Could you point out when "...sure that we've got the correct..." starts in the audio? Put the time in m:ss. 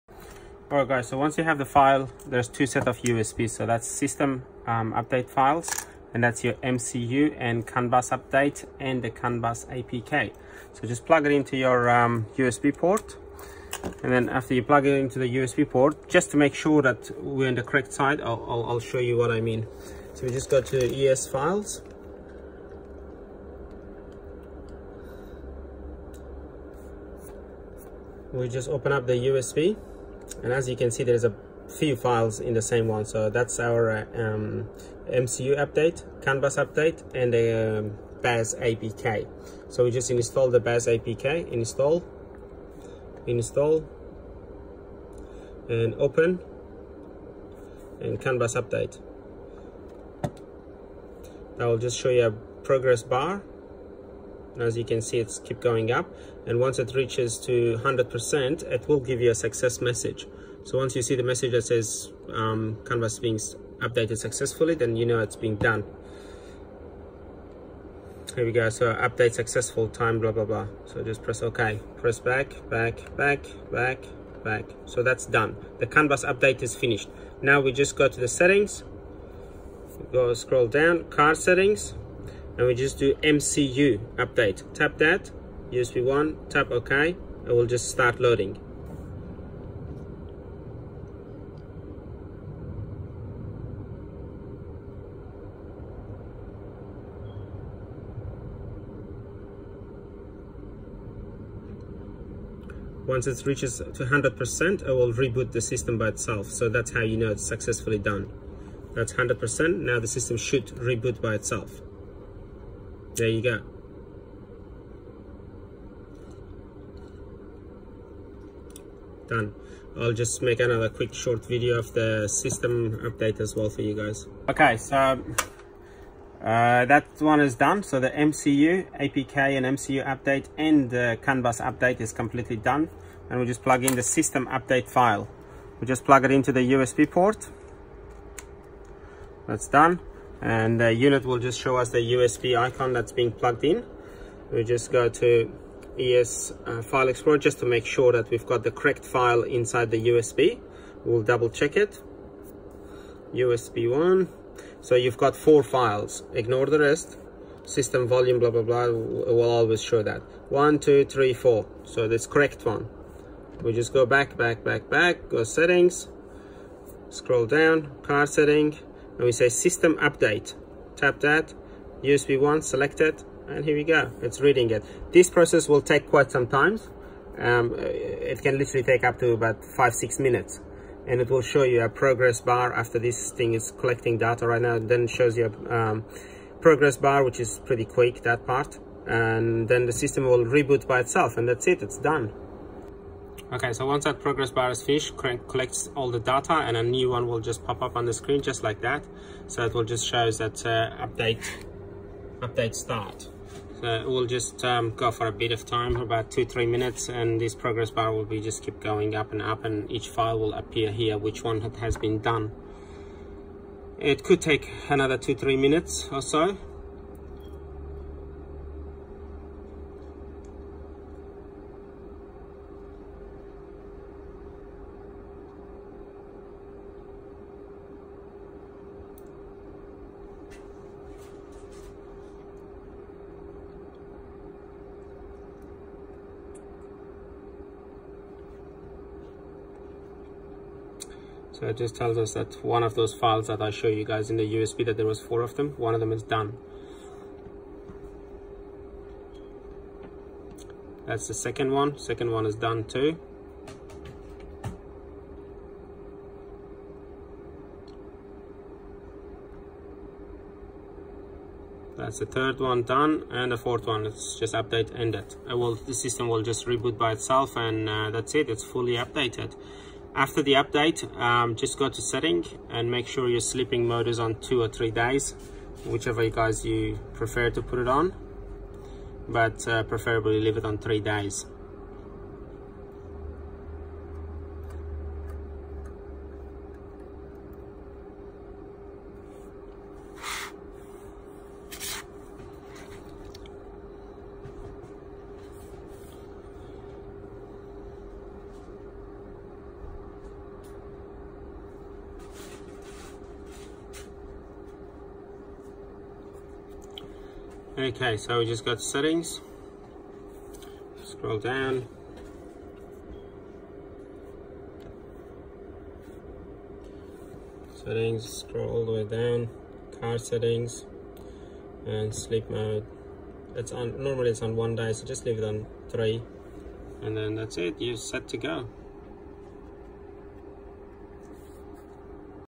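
2:27.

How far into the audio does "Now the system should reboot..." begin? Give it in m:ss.
1:49.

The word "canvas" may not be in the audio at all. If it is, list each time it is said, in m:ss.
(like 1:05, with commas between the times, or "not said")
0:48.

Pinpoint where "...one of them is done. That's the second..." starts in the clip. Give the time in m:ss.
4:05.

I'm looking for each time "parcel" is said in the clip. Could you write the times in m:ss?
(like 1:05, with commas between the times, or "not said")
not said.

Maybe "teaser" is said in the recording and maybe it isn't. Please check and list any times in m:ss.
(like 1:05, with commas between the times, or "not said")
not said.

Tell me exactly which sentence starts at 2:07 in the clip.
So the MCU, APK and MCU update and the CAN bus update is completely done.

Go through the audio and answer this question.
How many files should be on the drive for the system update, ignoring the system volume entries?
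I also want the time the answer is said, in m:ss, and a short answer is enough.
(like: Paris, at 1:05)
4, at 2:35.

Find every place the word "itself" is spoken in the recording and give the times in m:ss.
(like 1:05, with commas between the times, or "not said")
1:46, 1:51, 3:10, 4:27.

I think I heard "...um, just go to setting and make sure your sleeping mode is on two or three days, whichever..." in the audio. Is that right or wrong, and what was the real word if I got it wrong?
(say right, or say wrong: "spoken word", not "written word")
right.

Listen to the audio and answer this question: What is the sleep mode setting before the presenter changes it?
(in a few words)
1 day.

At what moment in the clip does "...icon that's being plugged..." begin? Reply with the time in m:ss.
2:22.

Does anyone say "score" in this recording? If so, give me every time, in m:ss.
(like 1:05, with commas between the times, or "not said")
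not said.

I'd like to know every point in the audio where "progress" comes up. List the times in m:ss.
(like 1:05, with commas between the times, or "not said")
0:52, 3:01, 3:06, 3:14, 3:27.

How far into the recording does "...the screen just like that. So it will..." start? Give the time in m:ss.
3:18.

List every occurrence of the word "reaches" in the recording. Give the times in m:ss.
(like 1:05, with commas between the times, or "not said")
0:56, 1:43.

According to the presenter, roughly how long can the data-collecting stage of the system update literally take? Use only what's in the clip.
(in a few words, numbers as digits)
5-6 minutes.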